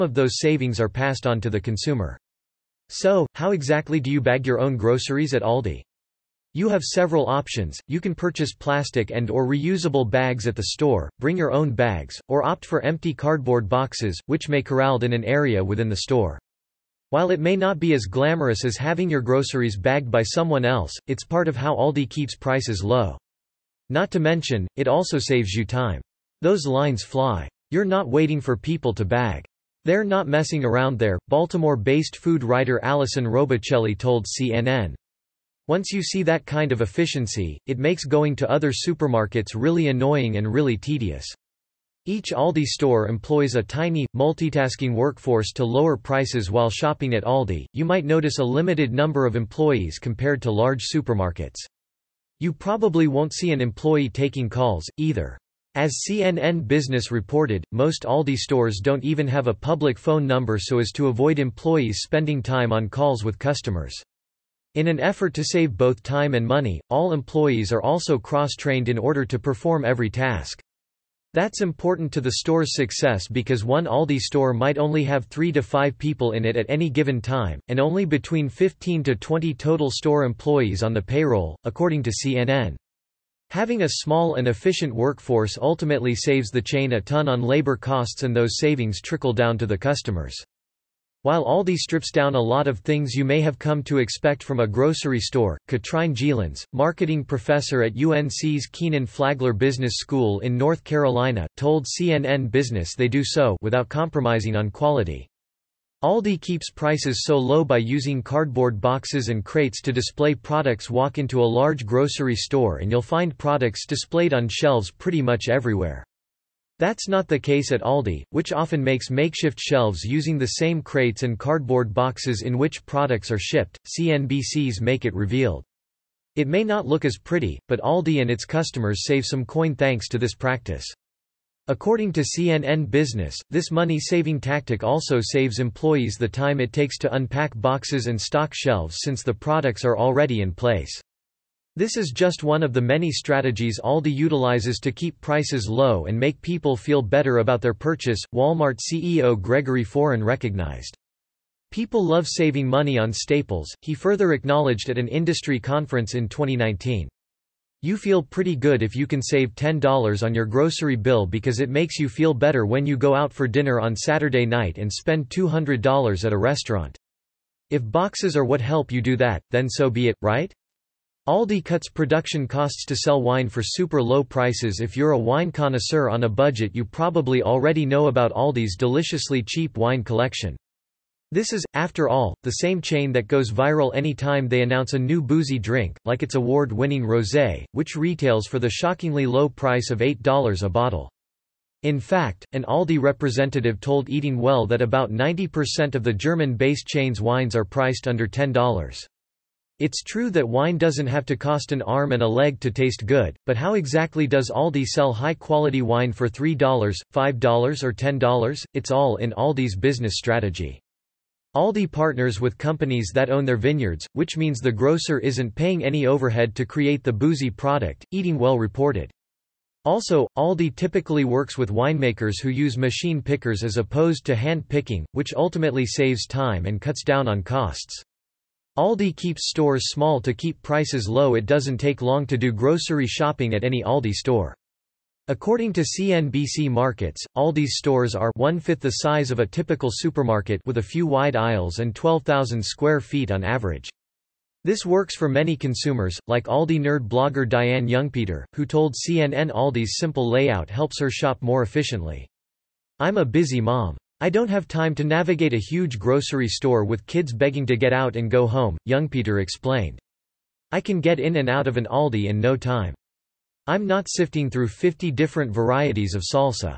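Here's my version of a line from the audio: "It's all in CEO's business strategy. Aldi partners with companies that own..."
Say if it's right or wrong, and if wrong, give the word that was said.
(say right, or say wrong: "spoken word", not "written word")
wrong: "Aldi", not "CEO".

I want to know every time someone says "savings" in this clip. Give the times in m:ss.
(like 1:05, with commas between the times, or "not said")
0:00, 1:28, 2:13, 2:32.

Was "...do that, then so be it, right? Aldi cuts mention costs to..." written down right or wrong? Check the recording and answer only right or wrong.
wrong.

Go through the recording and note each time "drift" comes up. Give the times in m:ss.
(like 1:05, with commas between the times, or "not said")
not said.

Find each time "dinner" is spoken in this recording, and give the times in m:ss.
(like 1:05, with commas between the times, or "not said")
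2:43.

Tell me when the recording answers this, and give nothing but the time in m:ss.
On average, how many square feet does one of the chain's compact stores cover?
4:01.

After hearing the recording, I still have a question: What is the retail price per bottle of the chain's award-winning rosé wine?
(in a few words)
$8.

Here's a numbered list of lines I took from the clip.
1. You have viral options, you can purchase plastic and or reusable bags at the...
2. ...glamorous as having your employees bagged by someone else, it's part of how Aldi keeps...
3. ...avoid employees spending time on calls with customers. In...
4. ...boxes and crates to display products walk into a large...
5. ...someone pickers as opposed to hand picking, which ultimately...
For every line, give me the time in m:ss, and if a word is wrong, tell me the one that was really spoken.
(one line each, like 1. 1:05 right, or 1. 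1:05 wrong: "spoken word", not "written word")
1. 0:06 wrong: "several", not "viral"
2. 0:18 wrong: "groceries", not "employees"
3. 1:01 right
4. 1:48 right
5. 3:42 wrong: "machine", not "someone".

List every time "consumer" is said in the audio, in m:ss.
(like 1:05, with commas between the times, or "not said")
0:01, 4:05.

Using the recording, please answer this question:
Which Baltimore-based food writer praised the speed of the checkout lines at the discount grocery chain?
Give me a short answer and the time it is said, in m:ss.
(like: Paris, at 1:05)
Allison Robicelli, at 0:32.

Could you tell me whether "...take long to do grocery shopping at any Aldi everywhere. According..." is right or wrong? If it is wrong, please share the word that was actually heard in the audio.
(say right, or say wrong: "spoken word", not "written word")
wrong: "store", not "everywhere".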